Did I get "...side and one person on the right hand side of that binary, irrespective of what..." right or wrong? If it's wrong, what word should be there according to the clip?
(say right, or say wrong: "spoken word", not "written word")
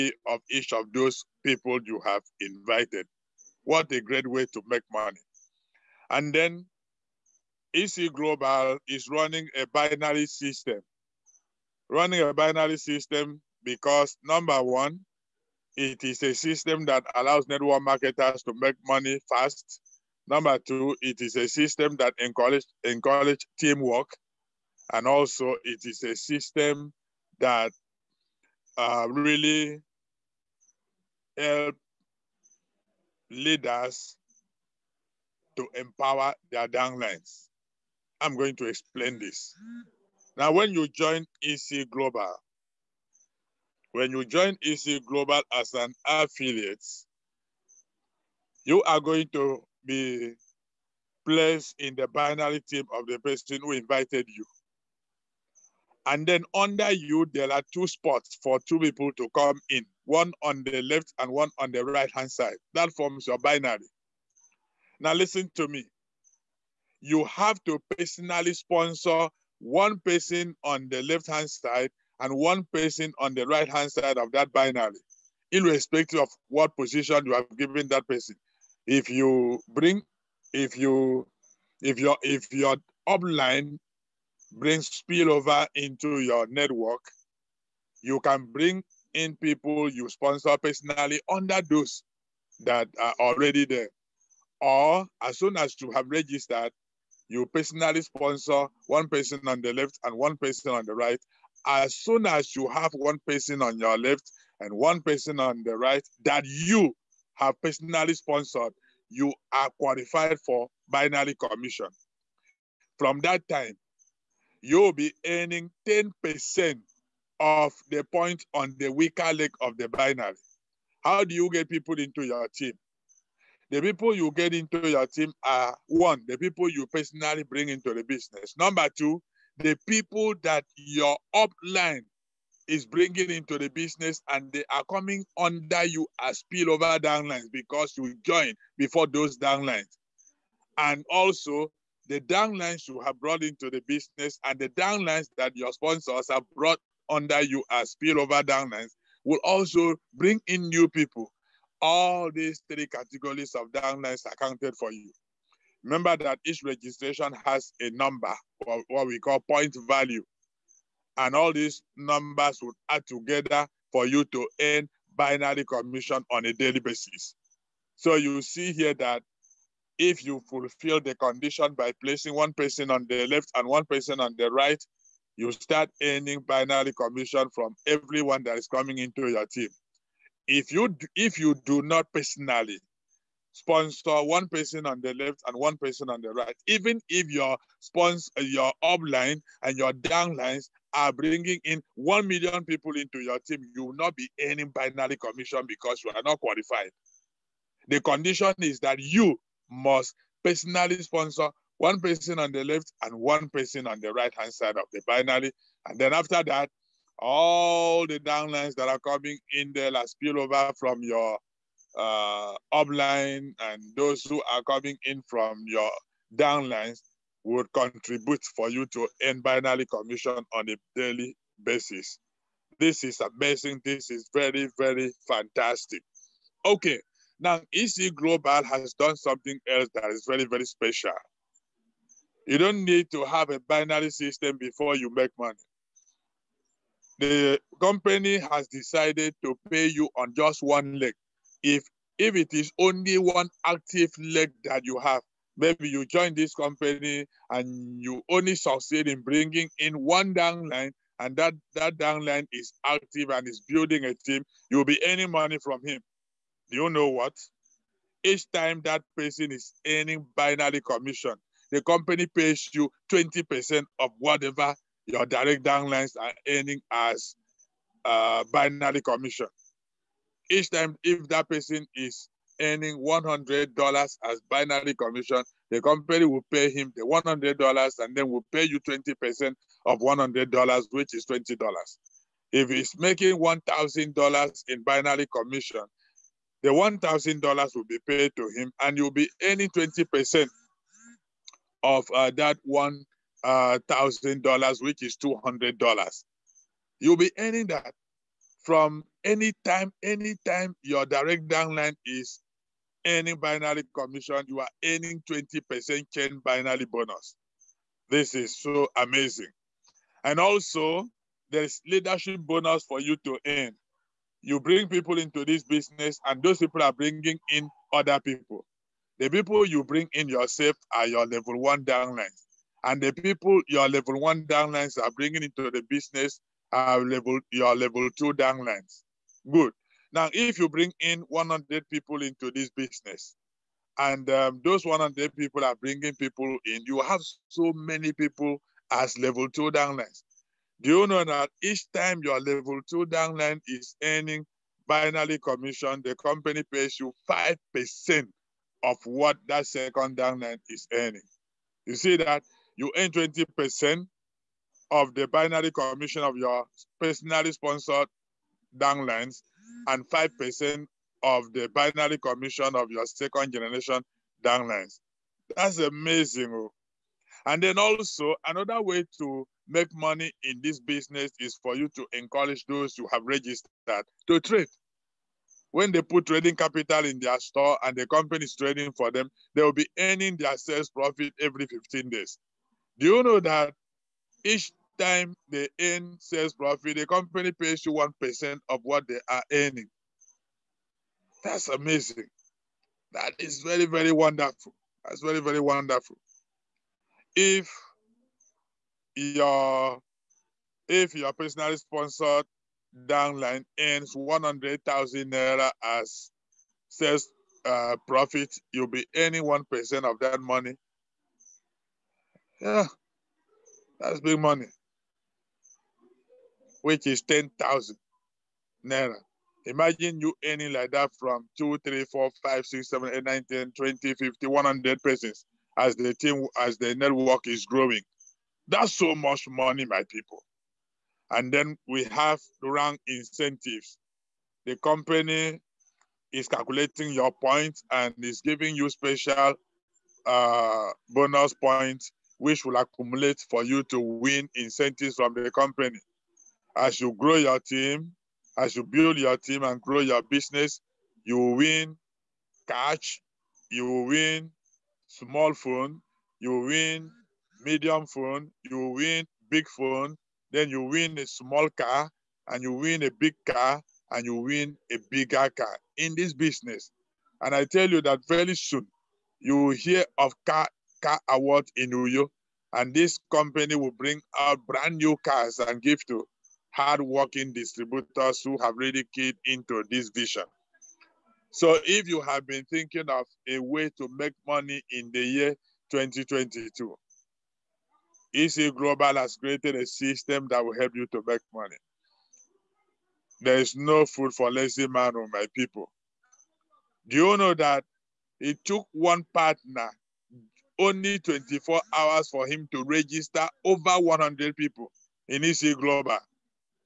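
right.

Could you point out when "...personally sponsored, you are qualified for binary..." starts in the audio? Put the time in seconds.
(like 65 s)
107 s.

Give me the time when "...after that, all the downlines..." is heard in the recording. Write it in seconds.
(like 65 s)
206 s.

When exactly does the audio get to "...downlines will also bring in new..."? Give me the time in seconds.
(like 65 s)
148 s.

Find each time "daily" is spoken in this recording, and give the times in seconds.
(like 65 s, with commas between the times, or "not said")
166 s, 220 s.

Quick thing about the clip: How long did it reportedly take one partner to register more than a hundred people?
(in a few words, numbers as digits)
24 hours.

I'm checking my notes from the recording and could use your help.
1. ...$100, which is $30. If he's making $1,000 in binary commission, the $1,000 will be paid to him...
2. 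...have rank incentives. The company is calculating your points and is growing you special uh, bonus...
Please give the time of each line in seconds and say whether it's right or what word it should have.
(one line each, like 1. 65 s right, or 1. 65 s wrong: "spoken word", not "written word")
1. 279 s wrong: "20", not "30"
2. 432 s wrong: "giving", not "growing".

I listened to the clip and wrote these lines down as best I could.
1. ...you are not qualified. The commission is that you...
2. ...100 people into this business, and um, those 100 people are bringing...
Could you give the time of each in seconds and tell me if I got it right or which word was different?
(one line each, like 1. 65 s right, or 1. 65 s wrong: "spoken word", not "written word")
1. 196 s wrong: "condition", not "commission"
2. 331 s right.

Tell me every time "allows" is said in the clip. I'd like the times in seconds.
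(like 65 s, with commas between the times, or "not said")
17 s.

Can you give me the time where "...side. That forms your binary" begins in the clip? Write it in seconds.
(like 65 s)
62 s.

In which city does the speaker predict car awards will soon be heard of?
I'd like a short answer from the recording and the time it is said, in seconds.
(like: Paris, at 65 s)
Uyo, at 471 s.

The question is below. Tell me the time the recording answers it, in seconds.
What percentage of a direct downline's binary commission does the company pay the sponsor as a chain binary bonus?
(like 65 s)
305 s.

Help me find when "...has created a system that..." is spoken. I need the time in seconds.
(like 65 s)
489 s.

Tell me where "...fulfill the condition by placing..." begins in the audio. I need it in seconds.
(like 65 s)
170 s.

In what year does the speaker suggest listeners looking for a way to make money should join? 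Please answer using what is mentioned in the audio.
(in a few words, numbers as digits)
2022.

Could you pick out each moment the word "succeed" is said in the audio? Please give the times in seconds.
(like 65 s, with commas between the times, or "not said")
248 s.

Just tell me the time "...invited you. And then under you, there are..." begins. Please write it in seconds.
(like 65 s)
53 s.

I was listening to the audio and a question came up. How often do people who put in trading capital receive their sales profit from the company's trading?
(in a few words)
every 15 days.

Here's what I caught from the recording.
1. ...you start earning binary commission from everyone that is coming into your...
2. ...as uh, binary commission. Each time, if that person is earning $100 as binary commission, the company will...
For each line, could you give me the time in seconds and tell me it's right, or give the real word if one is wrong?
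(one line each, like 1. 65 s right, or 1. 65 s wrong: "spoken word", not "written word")
1. 175 s right
2. 266 s right.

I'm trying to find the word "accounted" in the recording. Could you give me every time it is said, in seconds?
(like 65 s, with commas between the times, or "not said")
154 s.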